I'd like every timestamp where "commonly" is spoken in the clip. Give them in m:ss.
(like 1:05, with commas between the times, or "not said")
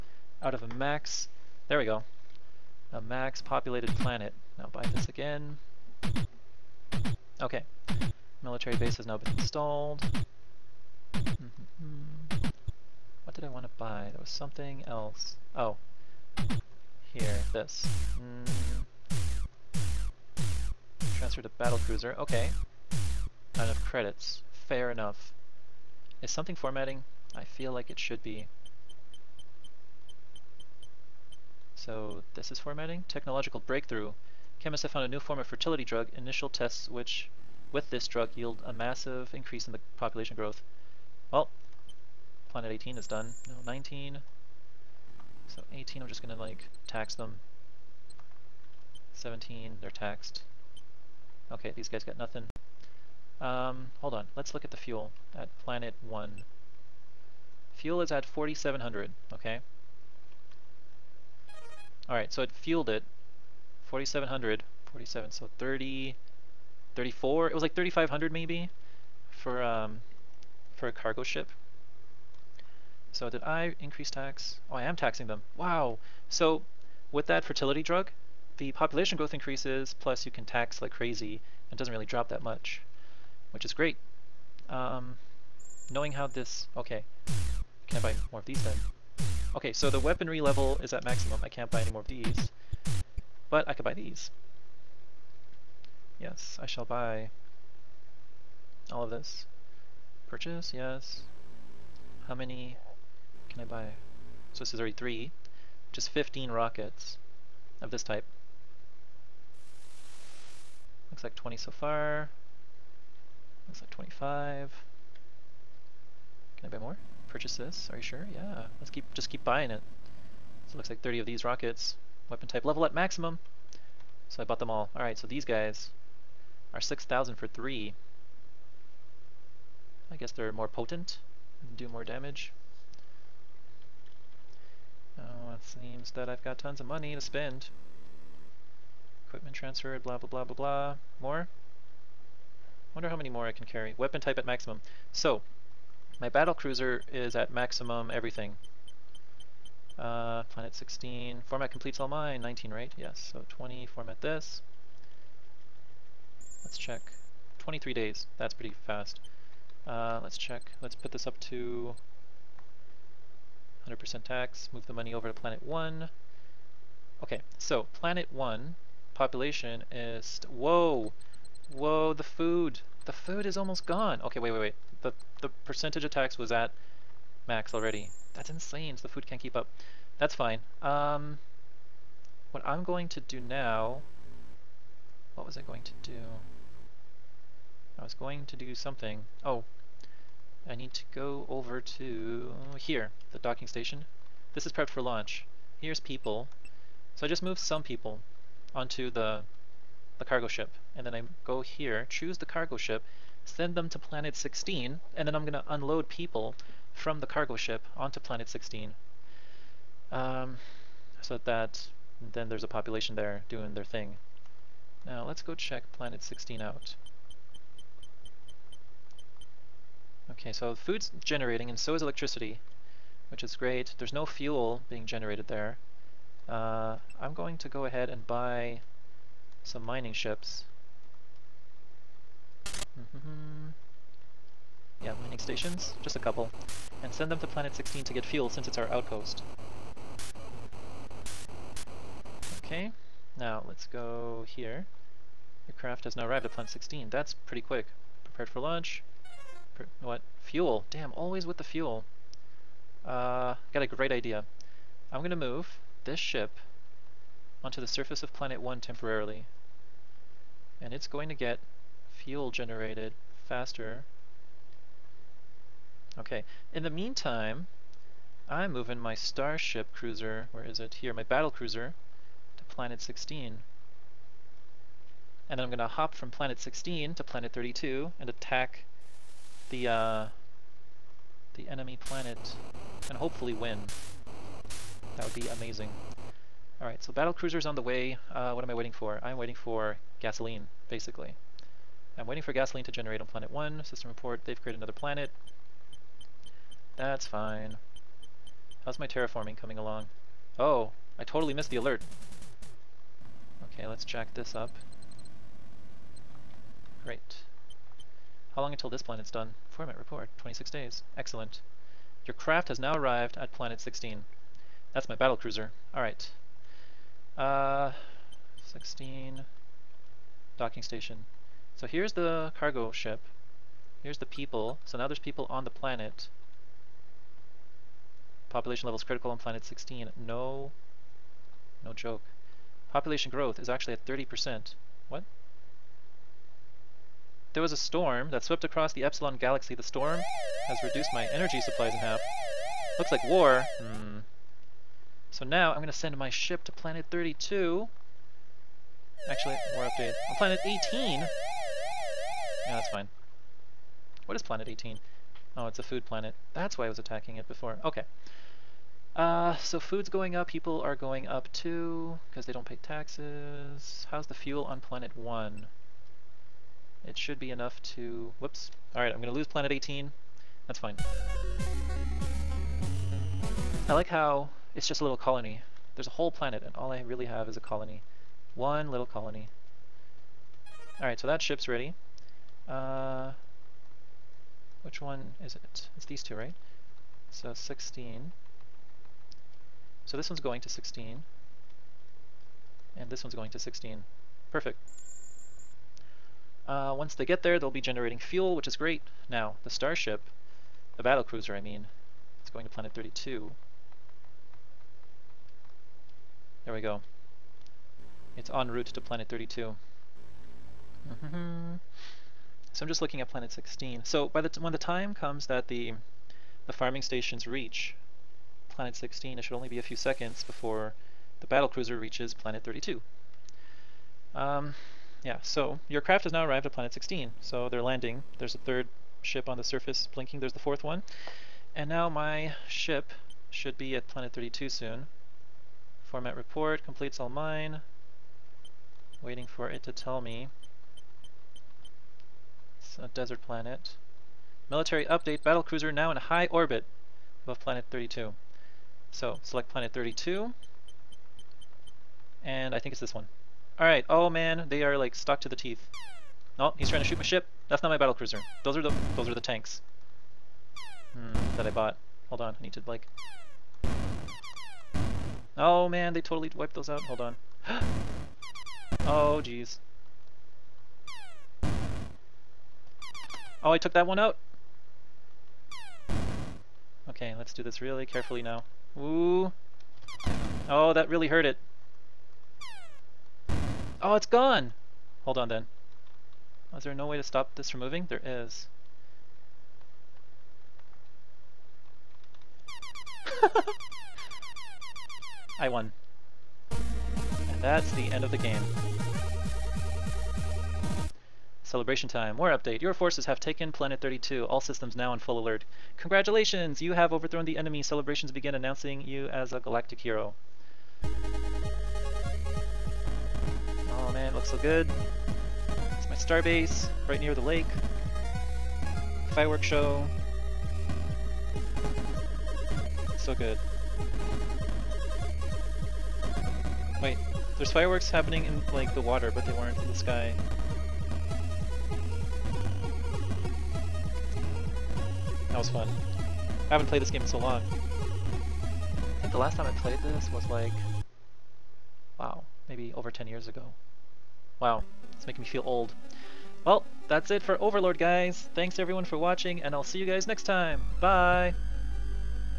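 not said.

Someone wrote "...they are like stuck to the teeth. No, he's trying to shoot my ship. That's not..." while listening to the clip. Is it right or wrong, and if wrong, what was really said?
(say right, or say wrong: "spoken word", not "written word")
right.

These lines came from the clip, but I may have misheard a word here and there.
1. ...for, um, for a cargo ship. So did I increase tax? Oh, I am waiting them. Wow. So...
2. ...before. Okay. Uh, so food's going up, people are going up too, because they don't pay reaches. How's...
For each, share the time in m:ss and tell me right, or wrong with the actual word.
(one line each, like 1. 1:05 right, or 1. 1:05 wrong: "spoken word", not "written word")
1. 1:09 wrong: "taxing", not "waiting"
2. 5:57 wrong: "taxes", not "reaches".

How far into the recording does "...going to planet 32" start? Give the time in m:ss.
6:42.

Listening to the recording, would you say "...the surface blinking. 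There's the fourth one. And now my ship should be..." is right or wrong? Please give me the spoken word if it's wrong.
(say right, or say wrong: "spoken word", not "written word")
right.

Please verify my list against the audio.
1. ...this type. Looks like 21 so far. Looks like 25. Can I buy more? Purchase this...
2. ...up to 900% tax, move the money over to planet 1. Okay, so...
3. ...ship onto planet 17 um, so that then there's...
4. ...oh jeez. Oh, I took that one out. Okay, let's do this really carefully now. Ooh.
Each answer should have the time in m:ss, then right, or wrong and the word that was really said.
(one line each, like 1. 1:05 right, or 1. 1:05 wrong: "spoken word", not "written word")
1. 1:47 wrong: "20", not "21"
2. 2:41 wrong: "100", not "900"
3. 3:27 wrong: "16", not "17"
4. 7:49 right.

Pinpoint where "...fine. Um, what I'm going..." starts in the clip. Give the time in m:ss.
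3:00.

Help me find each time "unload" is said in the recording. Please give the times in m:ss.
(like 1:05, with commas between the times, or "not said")
3:25.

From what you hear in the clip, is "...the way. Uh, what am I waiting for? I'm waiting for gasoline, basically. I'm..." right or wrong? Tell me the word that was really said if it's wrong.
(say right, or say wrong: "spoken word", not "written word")
right.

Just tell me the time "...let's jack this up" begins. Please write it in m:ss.
5:03.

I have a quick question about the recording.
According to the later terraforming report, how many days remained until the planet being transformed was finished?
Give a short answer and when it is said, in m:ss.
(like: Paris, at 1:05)
26, at 5:10.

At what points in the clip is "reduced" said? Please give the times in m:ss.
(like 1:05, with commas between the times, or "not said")
5:40.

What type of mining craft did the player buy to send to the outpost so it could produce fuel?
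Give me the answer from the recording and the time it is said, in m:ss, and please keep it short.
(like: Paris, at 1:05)
Mining stations, at 3:55.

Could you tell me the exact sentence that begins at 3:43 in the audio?
There's no fuel being generated there.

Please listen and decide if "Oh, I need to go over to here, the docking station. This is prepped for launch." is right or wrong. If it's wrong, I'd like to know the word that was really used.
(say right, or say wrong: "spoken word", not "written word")
right.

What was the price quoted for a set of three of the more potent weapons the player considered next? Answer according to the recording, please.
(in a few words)
6,000.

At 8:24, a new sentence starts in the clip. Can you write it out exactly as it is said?
All systems now on full alert.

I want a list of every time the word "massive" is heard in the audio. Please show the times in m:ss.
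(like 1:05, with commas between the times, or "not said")
0:38.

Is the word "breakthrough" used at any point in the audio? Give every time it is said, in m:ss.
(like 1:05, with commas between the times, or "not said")
0:33.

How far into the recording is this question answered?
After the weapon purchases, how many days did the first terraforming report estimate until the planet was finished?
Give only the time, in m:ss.
2:37.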